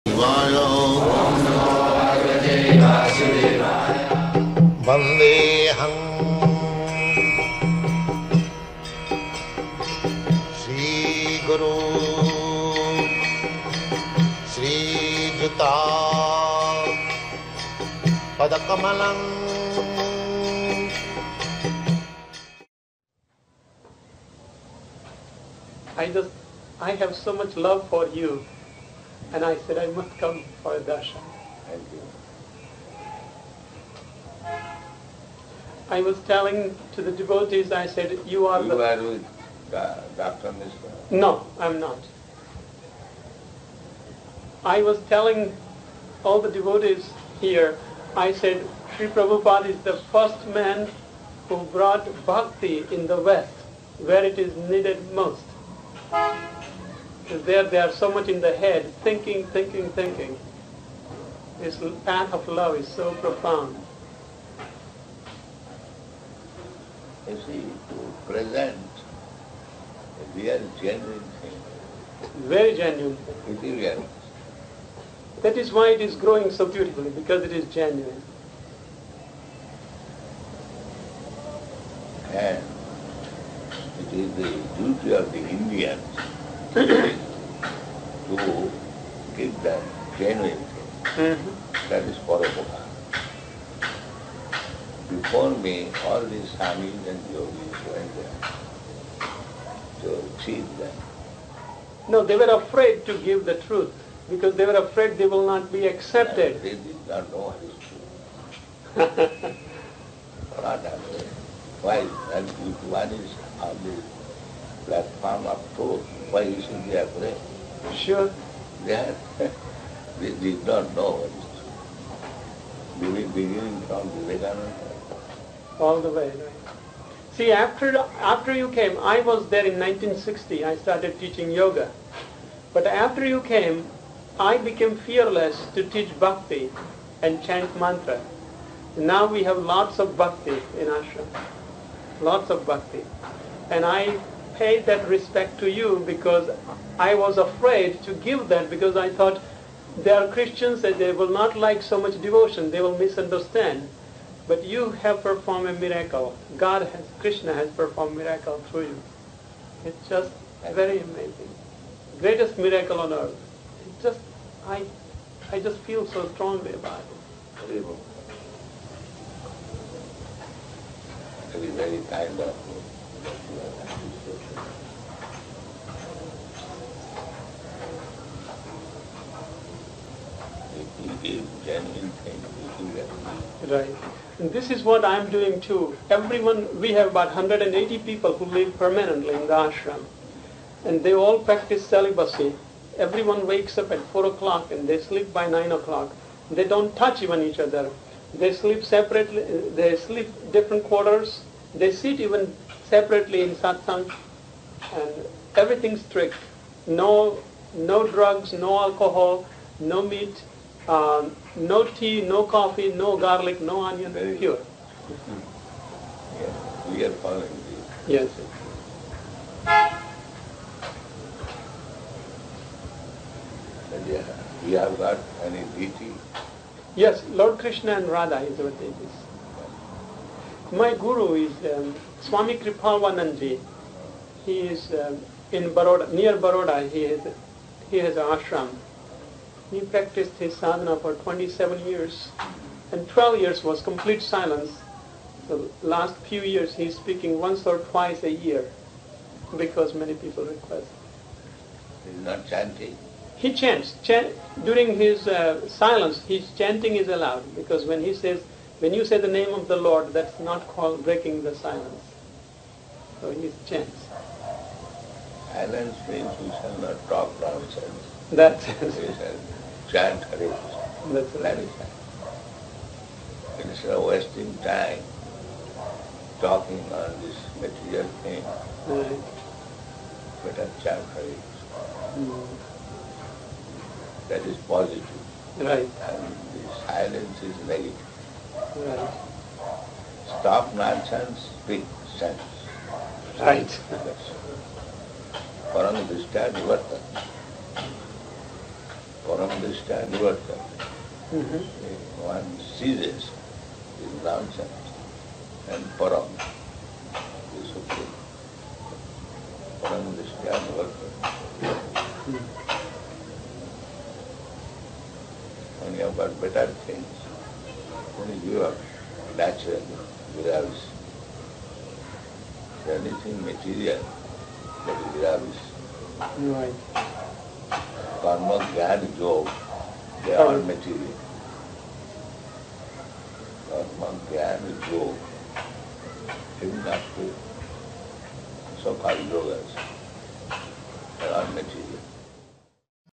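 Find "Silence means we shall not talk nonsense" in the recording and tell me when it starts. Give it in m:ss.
4:25.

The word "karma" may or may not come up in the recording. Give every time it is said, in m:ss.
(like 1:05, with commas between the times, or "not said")
5:28, 5:33.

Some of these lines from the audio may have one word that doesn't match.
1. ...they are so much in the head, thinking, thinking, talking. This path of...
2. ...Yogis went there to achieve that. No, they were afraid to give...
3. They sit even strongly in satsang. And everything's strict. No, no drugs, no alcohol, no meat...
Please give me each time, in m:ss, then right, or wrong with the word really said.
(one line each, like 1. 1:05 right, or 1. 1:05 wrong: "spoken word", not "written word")
1. 0:57 wrong: "thinking", not "talking"
2. 1:37 right
3. 3:21 wrong: "separately", not "strongly".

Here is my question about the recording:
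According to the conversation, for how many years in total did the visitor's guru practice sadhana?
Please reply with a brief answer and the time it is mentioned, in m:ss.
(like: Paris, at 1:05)
27, at 4:01.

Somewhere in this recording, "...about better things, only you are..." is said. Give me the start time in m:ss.
5:16.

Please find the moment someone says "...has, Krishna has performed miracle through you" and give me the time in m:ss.
2:36.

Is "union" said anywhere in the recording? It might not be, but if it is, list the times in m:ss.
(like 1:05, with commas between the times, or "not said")
not said.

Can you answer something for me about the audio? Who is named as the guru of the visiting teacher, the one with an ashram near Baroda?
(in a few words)
Swami Kripalvanandji.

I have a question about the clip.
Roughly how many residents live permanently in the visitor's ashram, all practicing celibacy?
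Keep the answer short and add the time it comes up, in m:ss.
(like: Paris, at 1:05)
180, at 3:07.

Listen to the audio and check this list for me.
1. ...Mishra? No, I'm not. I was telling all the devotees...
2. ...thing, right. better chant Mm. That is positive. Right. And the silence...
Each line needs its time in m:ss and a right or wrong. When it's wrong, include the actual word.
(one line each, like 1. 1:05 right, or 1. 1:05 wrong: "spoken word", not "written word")
1. 0:40 right
2. 4:38 right.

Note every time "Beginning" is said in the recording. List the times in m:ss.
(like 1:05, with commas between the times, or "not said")
2:03.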